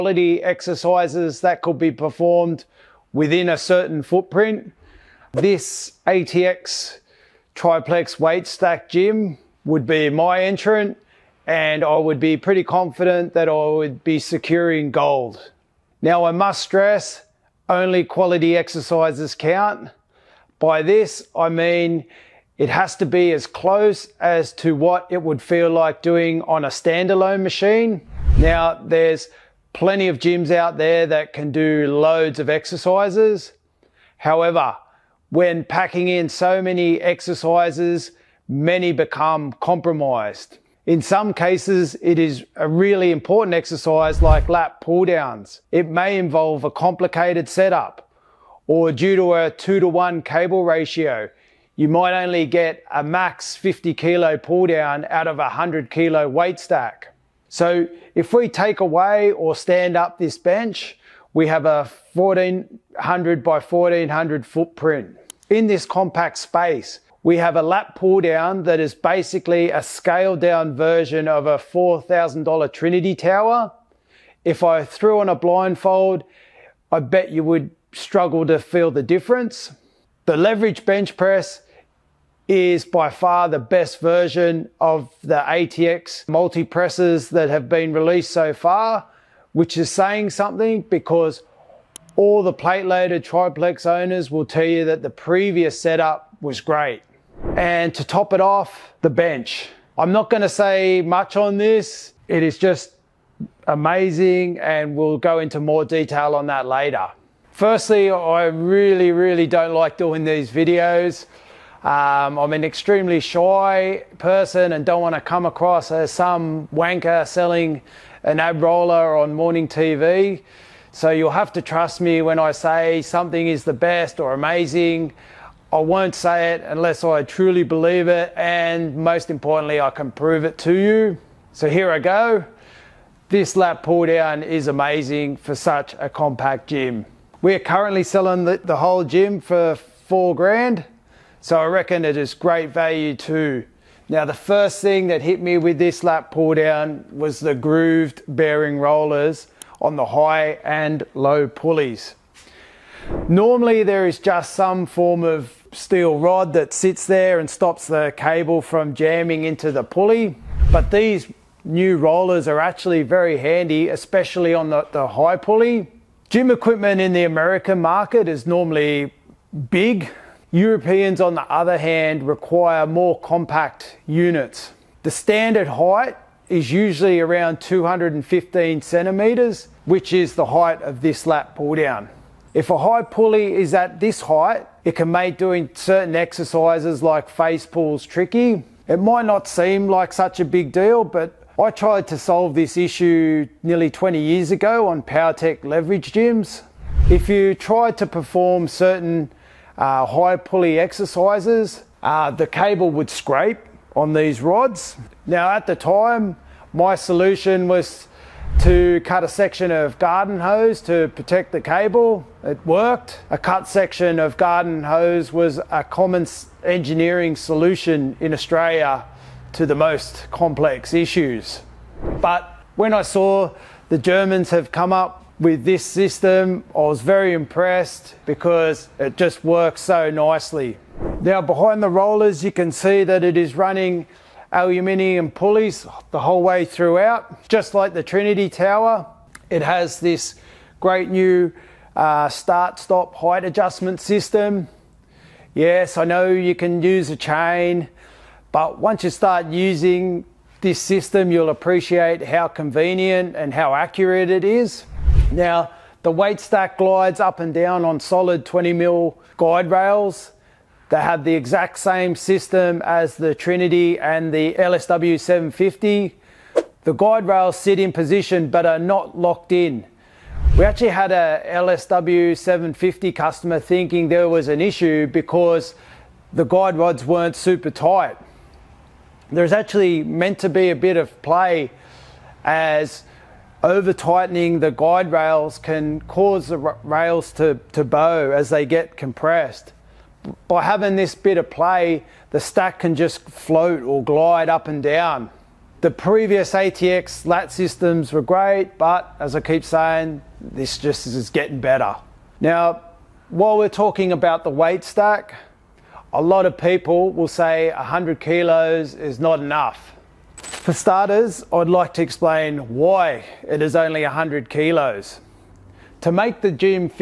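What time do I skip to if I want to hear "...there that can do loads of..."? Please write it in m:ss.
0:30.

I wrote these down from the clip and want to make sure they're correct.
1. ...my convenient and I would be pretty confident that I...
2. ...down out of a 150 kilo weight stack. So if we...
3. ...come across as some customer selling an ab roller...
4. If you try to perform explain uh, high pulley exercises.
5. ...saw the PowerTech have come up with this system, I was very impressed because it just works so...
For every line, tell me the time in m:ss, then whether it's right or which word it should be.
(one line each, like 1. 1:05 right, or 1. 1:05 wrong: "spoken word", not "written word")
1. 0:10 wrong: "entrant", not "convenient"
2. 0:54 wrong: "100", not "150"
3. 1:55 wrong: "wanker", not "customer"
4. 3:17 wrong: "certain", not "explain"
5. 3:43 wrong: "Germans", not "PowerTech".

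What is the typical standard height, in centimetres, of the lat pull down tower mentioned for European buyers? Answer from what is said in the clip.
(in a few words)
215 centimetres.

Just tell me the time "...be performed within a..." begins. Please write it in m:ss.
0:01.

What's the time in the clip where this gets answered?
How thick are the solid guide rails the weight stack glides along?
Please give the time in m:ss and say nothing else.
4:18.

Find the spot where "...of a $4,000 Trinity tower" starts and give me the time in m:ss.
1:11.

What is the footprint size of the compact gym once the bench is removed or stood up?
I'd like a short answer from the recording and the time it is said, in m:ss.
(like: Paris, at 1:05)
1400 by 1400, at 1:02.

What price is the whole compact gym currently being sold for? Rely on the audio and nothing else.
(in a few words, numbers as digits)
4 grand.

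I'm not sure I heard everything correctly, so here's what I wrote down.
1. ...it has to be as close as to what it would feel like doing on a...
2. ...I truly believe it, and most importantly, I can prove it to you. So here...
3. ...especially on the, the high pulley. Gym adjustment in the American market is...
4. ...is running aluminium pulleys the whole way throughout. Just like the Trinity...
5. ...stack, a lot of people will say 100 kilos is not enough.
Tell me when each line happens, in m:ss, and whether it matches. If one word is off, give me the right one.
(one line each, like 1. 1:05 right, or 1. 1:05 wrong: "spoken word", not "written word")
1. 0:22 right
2. 2:07 right
3. 2:43 wrong: "equipment", not "adjustment"
4. 3:53 right
5. 5:04 right.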